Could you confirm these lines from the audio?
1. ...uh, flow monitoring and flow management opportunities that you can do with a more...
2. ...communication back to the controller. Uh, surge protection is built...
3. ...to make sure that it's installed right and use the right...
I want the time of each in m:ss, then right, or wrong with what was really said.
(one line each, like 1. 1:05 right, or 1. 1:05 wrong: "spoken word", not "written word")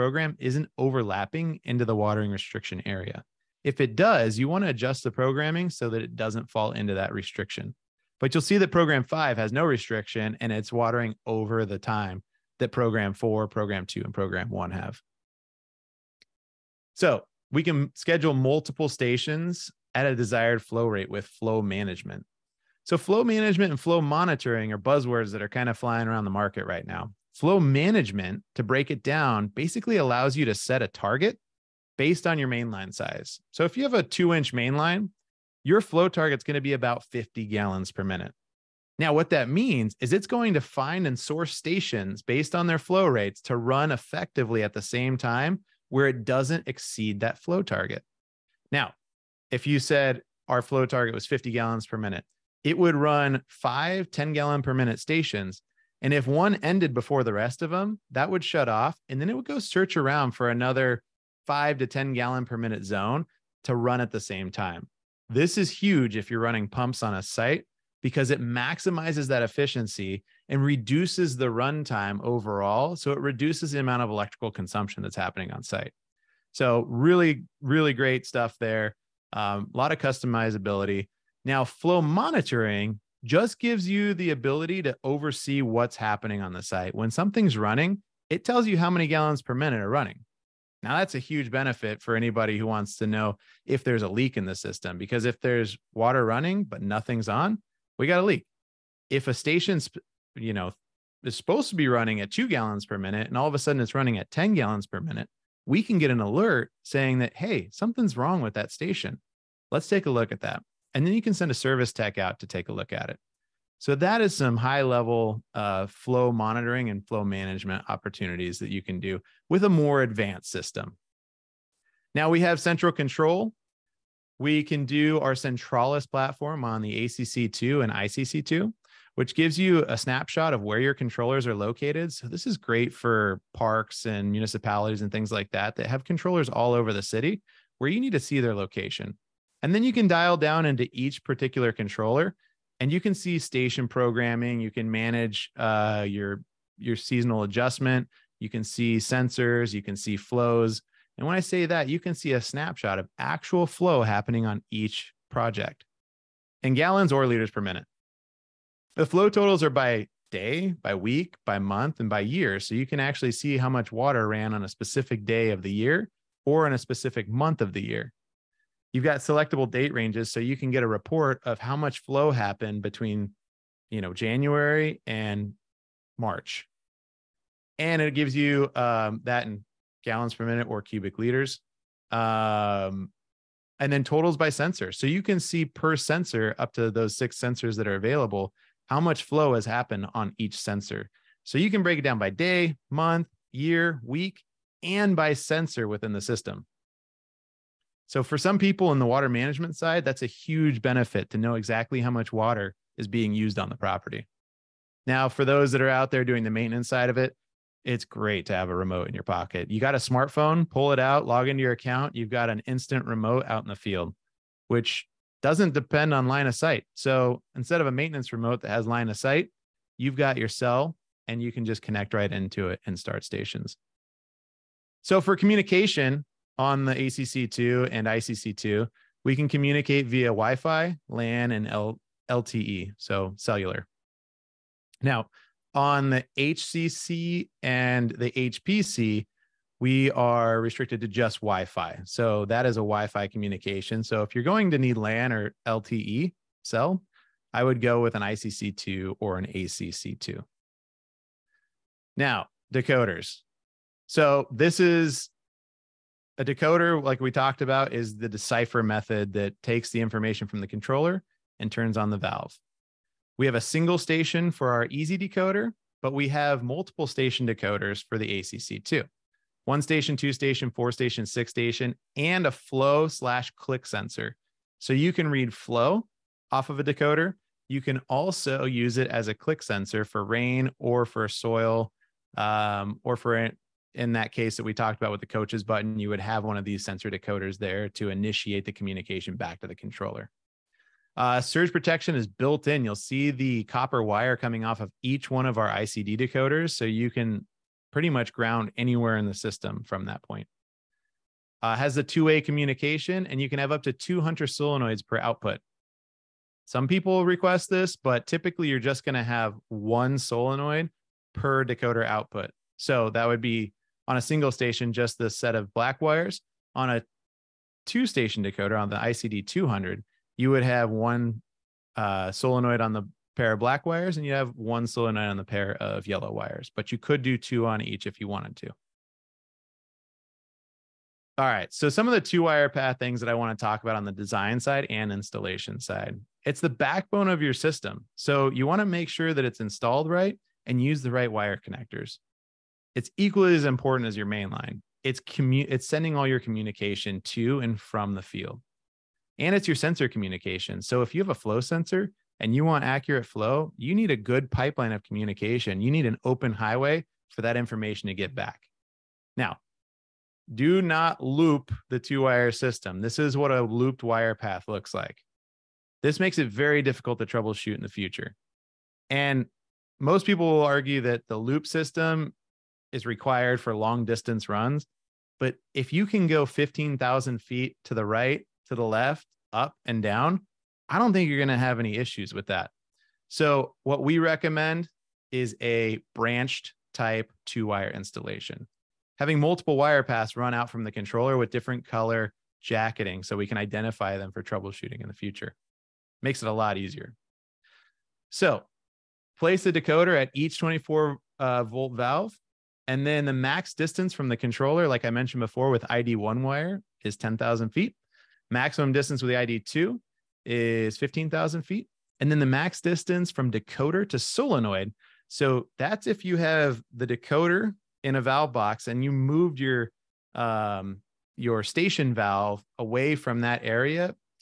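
1. 1:55 right
2. 4:48 right
3. 5:38 right.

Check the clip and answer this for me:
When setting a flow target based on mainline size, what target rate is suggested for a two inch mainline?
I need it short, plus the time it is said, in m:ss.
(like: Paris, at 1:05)
50 gallons per minute, at 0:36.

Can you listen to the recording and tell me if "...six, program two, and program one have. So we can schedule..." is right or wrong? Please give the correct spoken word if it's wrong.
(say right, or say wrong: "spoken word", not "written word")
wrong: "four", not "six".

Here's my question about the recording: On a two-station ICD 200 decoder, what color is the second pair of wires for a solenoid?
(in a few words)
yellow.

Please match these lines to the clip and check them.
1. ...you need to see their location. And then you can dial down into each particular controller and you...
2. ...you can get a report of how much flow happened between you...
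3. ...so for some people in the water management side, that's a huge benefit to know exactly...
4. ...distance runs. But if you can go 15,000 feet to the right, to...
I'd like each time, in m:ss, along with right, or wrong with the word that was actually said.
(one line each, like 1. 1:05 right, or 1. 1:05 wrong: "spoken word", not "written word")
1. 2:17 right
2. 2:50 right
3. 3:18 right
4. 6:14 right.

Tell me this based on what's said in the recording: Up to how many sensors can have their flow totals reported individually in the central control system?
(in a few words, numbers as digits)
6.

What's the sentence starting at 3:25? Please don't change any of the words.
Now, for those that are out there doing the maintenance side of it, it's great to have a remote in your pocket.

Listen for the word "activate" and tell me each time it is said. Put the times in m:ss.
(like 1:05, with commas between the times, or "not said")
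not said.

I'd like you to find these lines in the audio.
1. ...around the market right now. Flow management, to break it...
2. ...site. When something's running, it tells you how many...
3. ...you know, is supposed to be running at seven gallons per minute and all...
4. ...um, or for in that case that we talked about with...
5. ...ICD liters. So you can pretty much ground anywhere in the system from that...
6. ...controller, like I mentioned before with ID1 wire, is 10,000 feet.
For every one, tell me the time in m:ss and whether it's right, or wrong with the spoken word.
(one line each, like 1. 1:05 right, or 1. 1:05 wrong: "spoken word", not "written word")
1. 0:26 right
2. 1:26 right
3. 1:40 wrong: "two", not "seven"
4. 4:42 right
5. 4:55 wrong: "decoders", not "liters"
6. 6:44 right.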